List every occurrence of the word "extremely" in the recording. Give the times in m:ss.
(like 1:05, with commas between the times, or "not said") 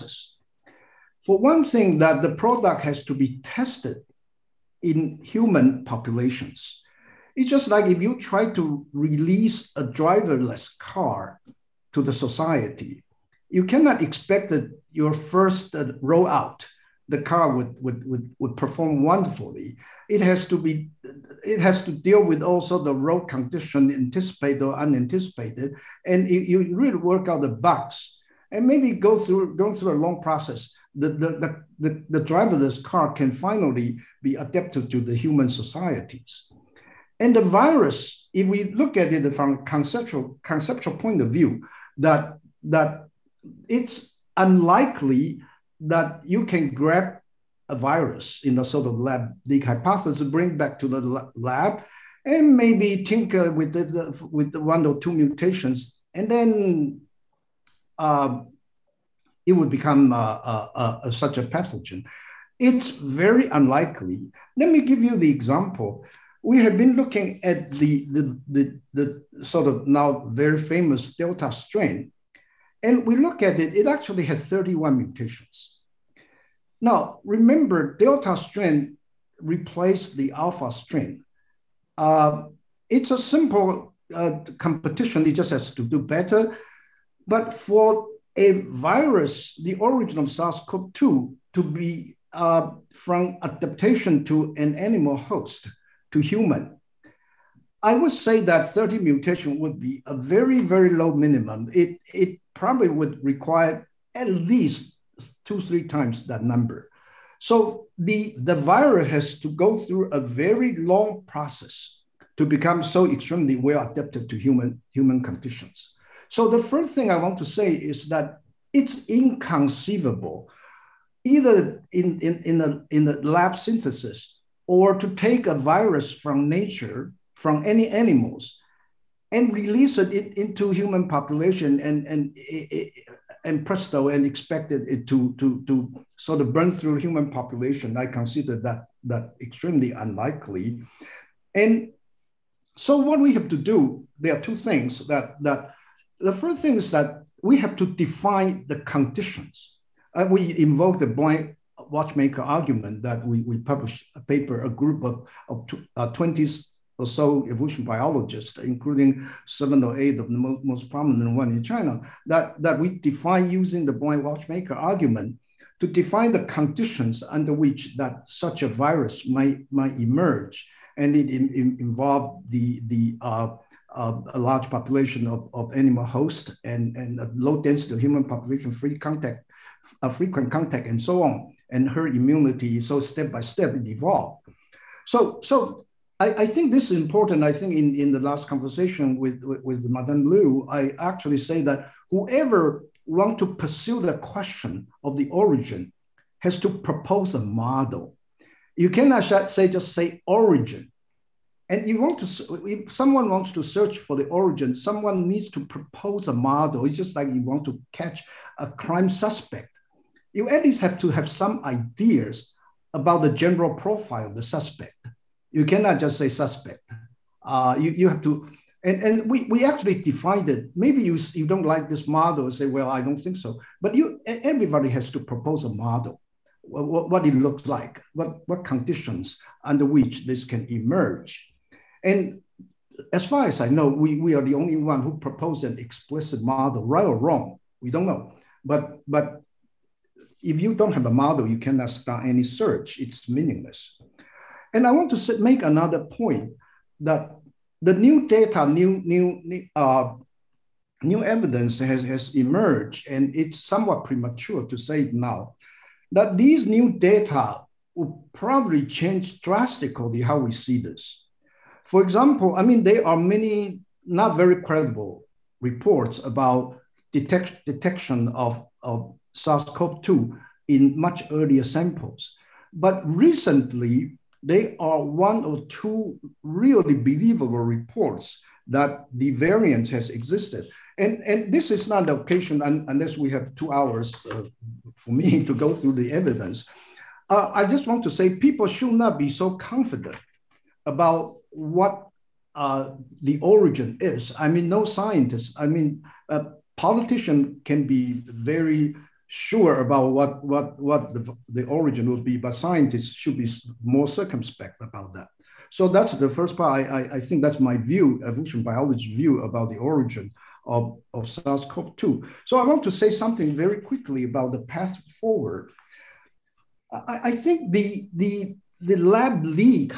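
1:53, 2:19.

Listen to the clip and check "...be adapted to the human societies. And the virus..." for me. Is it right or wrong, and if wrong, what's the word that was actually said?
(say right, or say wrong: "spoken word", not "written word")
right.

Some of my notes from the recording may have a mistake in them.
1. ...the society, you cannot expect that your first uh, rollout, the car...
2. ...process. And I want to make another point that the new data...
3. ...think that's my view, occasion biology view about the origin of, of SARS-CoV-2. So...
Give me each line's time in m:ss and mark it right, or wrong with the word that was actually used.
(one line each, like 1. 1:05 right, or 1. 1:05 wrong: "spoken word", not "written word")
1. 0:12 right
2. 4:03 wrong: "meaningless", not "process"
3. 5:07 wrong: "evolution", not "occasion".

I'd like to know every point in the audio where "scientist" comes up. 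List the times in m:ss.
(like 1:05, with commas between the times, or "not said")
4:54, 5:02.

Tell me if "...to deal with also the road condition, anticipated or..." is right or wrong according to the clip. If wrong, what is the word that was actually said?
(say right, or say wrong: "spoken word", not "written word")
right.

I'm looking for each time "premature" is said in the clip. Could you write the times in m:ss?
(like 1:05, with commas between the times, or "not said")
4:14.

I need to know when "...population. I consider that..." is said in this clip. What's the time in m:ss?
2:17.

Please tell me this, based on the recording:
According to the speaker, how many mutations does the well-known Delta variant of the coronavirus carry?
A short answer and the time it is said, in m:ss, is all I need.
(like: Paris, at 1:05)
31, at 1:14.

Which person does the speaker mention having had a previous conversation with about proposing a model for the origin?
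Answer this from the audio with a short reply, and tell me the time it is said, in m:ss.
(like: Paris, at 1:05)
Madame Liu, at 3:09.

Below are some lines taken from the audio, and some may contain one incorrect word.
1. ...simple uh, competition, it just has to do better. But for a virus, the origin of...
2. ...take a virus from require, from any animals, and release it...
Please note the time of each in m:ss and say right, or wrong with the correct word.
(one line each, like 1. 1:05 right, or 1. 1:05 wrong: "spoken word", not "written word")
1. 1:23 right
2. 2:05 wrong: "nature", not "require".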